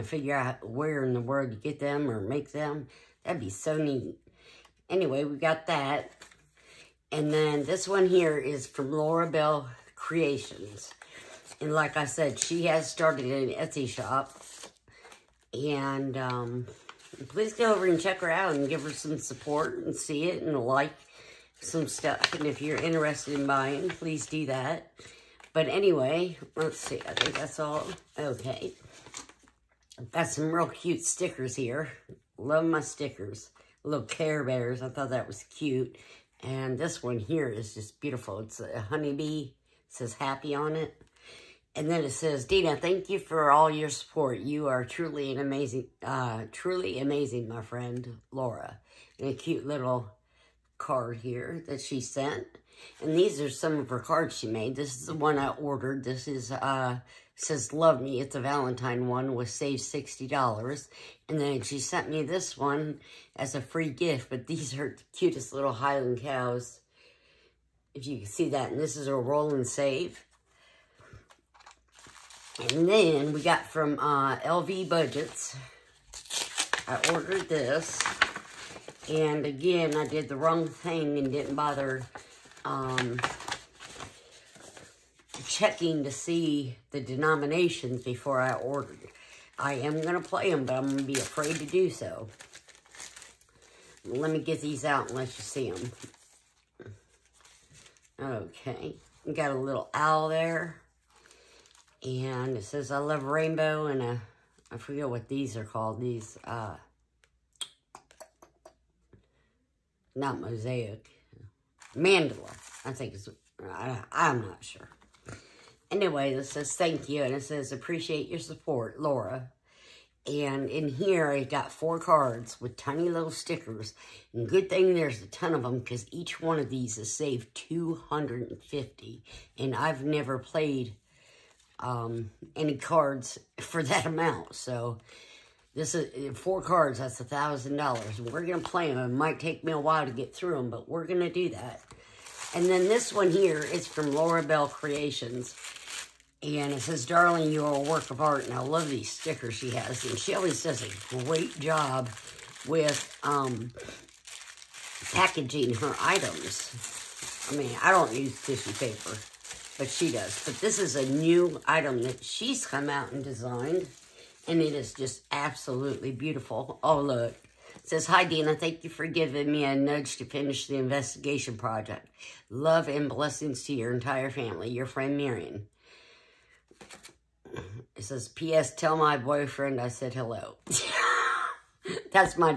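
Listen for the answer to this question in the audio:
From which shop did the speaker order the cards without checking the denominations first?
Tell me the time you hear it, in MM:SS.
01:14.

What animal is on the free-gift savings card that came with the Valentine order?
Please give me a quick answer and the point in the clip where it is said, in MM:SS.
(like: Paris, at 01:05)
Highland cows, at 01:05.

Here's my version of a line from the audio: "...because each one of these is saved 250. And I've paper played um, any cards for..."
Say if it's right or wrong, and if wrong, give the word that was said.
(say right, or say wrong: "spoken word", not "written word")
wrong: "never", not "paper".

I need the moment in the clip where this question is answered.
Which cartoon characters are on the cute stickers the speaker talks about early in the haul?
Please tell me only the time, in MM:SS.
00:34.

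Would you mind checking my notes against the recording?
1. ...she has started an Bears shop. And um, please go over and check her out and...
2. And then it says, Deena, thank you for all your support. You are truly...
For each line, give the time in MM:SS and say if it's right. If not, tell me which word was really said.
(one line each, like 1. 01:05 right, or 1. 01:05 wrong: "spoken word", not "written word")
1. 00:12 wrong: "Etsy", not "Bears"
2. 00:41 right.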